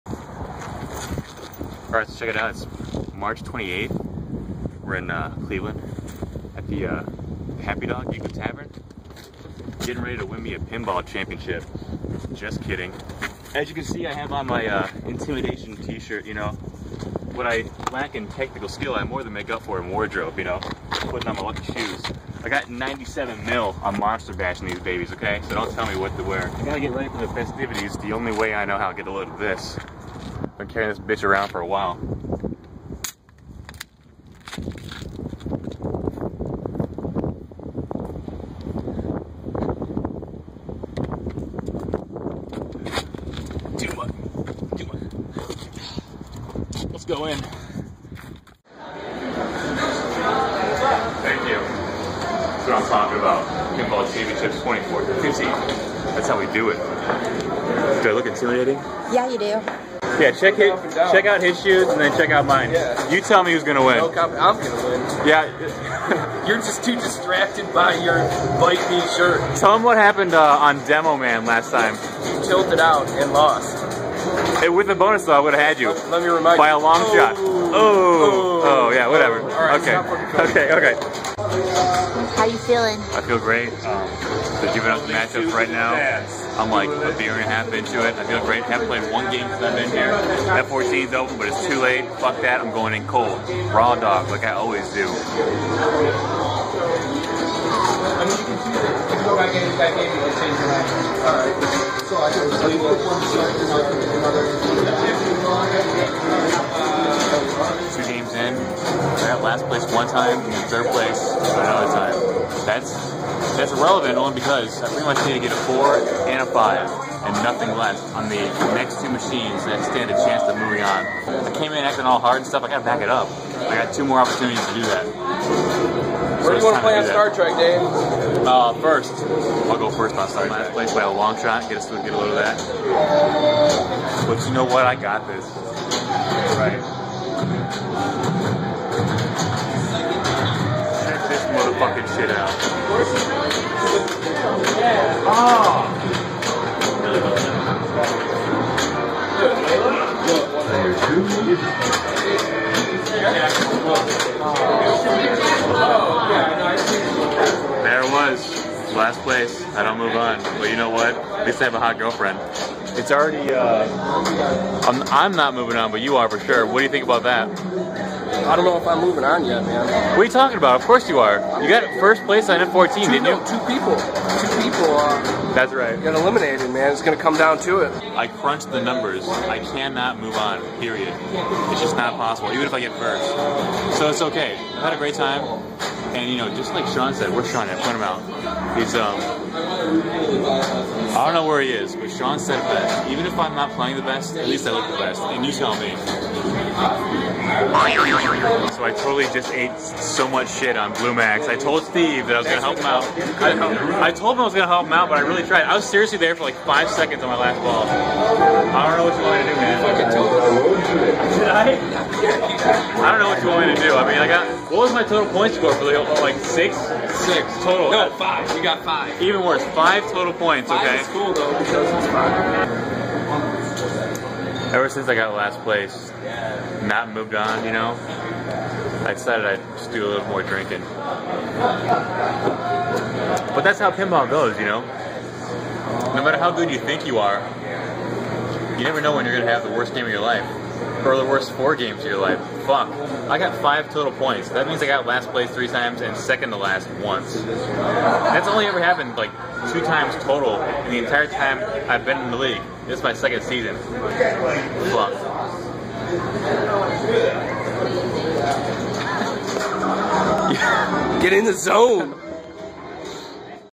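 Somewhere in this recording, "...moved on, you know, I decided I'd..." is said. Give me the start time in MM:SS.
03:47.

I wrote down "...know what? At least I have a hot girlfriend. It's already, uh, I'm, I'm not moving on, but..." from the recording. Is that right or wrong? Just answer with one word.
right.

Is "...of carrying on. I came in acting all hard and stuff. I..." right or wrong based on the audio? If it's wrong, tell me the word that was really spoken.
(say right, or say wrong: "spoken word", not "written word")
wrong: "moving", not "carrying".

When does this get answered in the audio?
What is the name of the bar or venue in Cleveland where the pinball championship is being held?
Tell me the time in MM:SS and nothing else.
00:07.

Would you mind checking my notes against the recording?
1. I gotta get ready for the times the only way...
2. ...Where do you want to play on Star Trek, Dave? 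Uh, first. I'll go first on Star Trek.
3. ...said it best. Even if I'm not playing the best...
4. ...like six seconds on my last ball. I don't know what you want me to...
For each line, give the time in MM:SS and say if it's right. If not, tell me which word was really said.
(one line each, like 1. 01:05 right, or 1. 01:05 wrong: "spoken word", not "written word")
1. 00:26 wrong: "festivities", not "times"
2. 02:06 right
3. 03:12 right
4. 03:26 wrong: "five", not "six".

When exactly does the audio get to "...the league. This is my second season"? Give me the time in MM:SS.
04:12.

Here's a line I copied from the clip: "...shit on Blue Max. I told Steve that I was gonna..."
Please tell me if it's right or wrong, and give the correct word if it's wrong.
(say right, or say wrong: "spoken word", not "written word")
right.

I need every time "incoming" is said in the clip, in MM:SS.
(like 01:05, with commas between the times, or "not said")
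not said.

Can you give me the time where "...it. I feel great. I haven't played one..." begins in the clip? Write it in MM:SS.
01:28.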